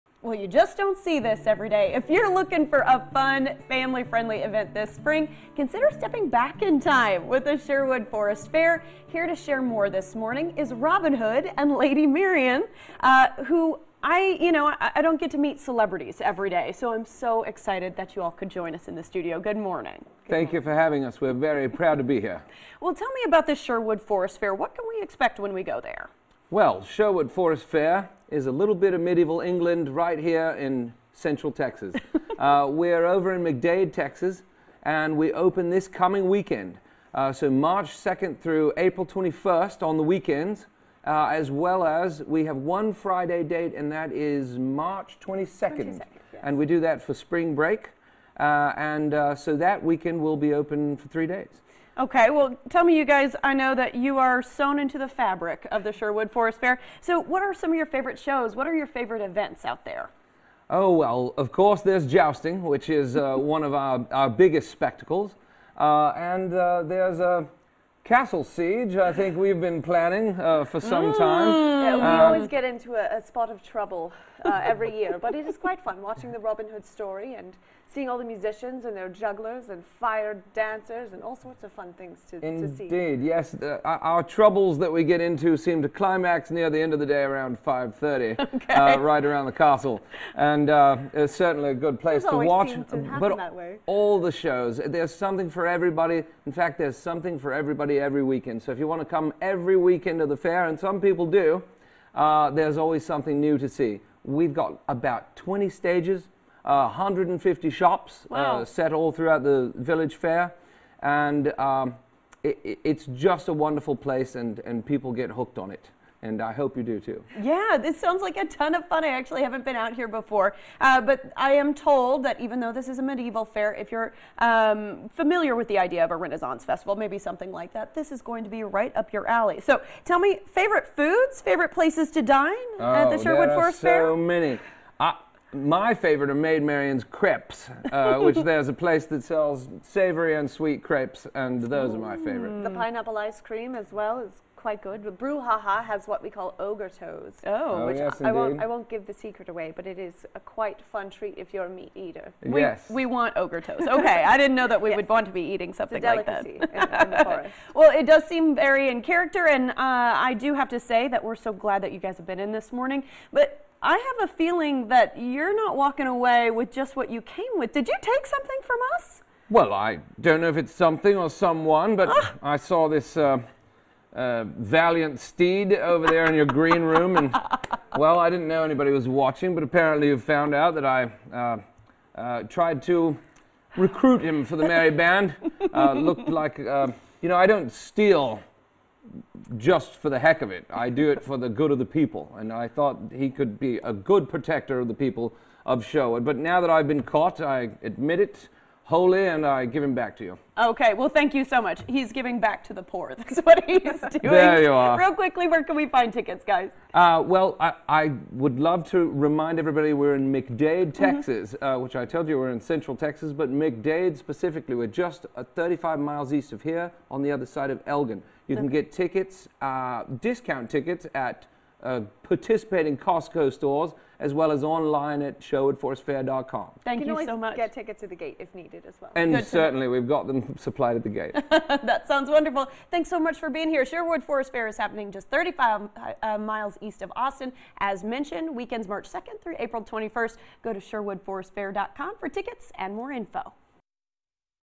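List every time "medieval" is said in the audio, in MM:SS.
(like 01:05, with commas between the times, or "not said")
00:28, 02:03.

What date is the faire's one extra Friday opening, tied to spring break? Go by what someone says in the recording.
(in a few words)
March 22nd.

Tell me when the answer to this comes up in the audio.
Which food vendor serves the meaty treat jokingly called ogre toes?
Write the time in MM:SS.
02:25.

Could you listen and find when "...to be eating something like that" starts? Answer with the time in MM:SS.
02:35.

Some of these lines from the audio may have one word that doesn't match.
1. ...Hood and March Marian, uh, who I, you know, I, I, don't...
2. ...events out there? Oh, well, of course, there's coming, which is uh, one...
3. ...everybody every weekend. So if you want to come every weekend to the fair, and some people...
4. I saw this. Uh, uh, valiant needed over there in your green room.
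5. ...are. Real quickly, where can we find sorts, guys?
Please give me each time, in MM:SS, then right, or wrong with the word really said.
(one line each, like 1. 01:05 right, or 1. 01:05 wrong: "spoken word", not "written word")
1. 00:11 wrong: "Lady", not "March"
2. 00:59 wrong: "jousting", not "coming"
3. 01:37 right
4. 02:52 wrong: "steed", not "needed"
5. 03:24 wrong: "tickets", not "sorts".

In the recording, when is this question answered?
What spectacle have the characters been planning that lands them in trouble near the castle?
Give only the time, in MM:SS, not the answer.
01:08.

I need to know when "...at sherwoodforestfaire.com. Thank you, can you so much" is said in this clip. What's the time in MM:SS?
03:45.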